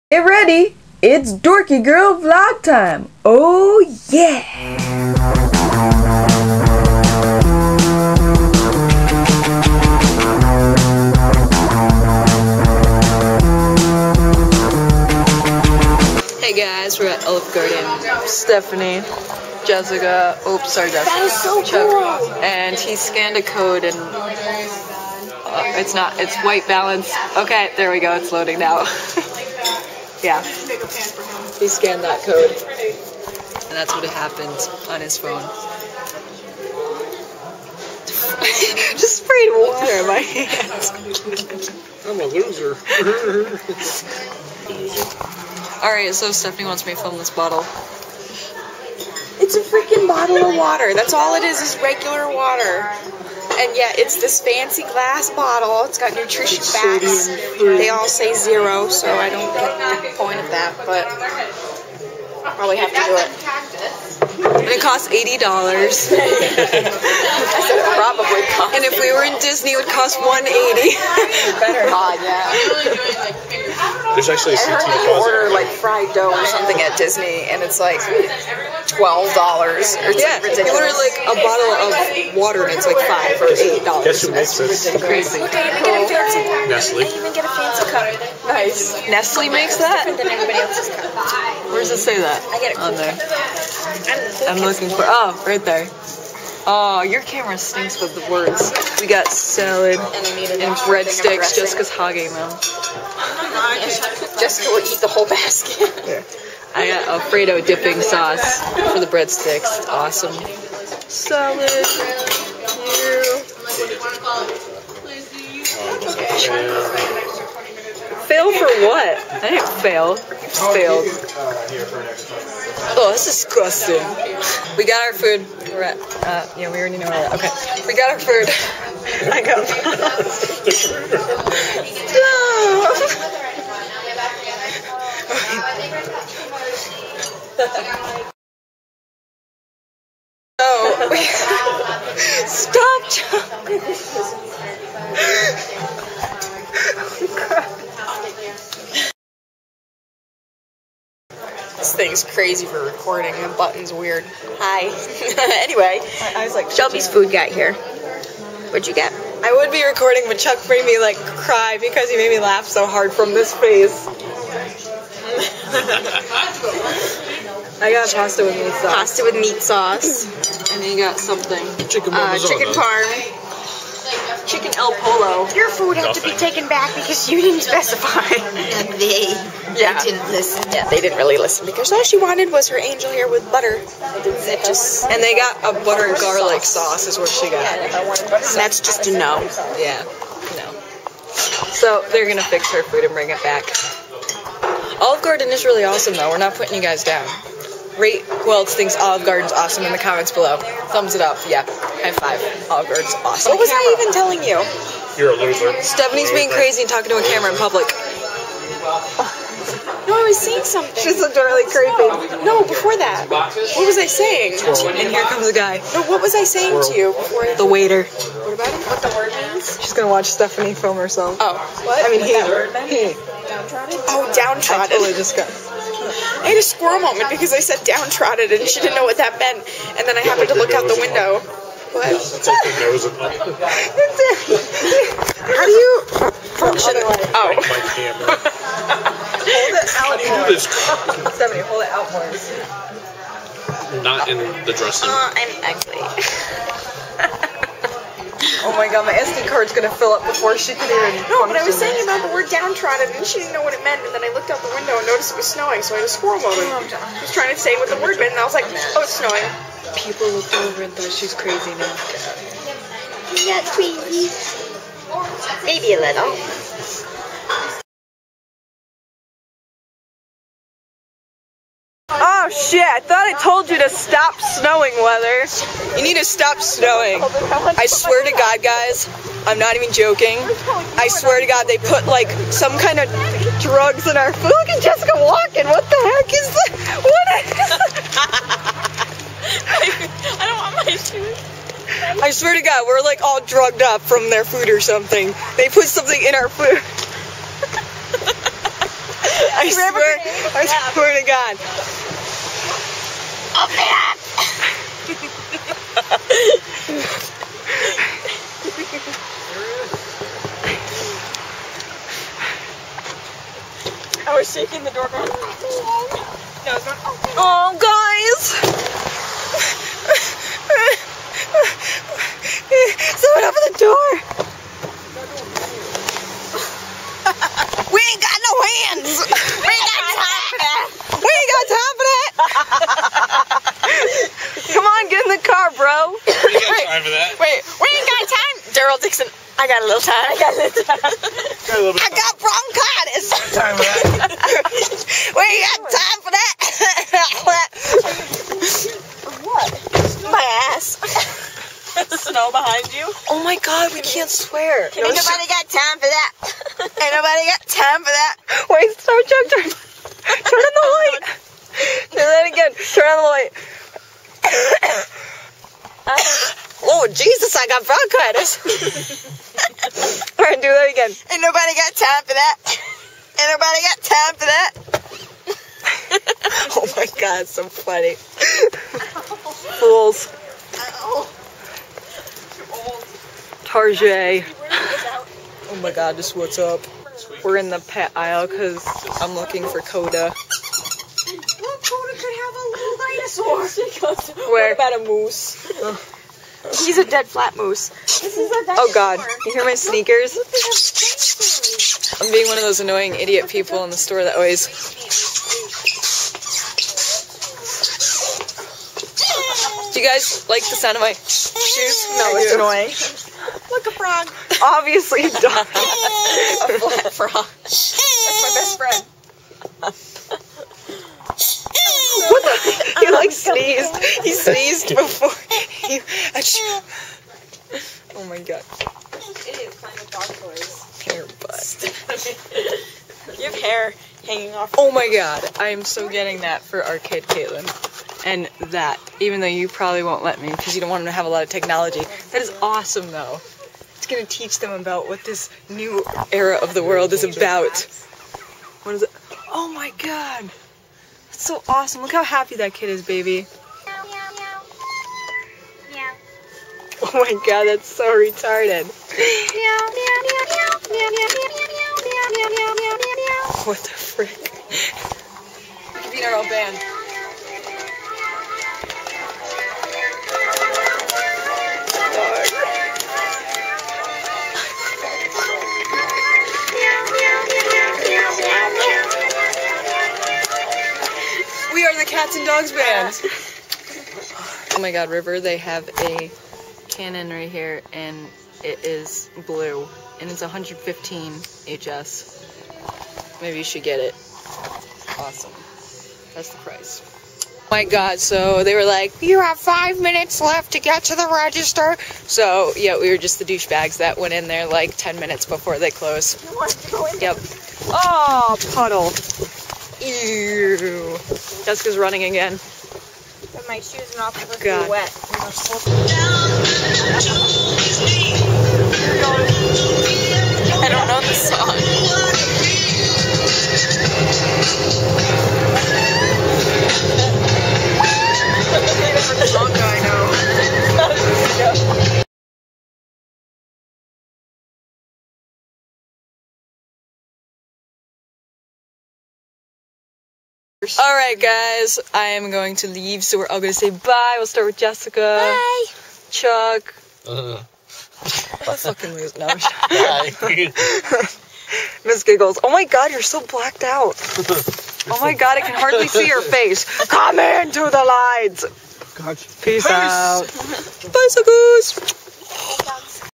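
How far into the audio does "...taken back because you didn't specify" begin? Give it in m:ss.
2:56.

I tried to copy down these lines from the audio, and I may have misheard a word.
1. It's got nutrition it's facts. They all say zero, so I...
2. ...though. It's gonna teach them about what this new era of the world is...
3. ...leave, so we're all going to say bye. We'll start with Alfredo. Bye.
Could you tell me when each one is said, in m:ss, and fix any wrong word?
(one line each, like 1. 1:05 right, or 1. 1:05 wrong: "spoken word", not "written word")
1. 0:55 right
2. 7:23 right
3. 9:02 wrong: "Jessica", not "Alfredo".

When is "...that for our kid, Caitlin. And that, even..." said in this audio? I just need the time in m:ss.
7:16.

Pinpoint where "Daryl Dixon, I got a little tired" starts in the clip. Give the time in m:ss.
5:38.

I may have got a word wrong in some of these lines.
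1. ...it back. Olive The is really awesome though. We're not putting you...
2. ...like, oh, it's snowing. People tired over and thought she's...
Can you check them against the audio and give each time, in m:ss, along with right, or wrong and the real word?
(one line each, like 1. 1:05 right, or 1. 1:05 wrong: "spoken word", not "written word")
1. 3:13 wrong: "Garden", not "The"
2. 4:18 wrong: "looked", not "tired".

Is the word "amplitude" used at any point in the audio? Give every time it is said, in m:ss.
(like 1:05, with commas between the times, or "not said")
not said.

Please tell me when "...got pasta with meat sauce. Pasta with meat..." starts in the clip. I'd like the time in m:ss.
2:47.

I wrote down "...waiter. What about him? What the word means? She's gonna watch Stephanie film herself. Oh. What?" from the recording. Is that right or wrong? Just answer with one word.
right.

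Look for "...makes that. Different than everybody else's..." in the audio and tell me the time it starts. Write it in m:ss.
1:29.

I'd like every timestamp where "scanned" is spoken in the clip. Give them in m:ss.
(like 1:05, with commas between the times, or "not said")
0:22, 0:31.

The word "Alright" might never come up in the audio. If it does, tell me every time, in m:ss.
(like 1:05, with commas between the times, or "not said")
0:45.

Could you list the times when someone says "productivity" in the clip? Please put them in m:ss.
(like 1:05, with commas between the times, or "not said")
not said.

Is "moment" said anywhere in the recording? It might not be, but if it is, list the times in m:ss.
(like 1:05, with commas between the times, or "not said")
3:46, 4:16.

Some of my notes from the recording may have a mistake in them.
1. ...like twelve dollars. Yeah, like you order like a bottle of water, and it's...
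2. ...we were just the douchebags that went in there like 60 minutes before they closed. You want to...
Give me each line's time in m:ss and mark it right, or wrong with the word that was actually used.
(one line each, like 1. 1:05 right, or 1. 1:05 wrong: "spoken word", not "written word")
1. 1:17 right
2. 8:22 wrong: "10", not "60".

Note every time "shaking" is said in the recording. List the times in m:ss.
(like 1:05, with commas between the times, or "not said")
5:14.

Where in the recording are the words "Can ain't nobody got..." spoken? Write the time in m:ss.
5:54.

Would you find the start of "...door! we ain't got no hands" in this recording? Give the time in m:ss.
5:23.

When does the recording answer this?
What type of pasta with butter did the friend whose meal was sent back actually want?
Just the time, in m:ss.
3:02.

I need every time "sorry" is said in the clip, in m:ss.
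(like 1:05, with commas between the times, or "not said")
0:20.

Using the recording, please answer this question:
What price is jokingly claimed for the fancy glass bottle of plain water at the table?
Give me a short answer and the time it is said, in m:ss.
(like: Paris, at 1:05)
$80, at 1:05.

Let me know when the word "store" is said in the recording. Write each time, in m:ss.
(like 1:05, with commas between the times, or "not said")
6:43.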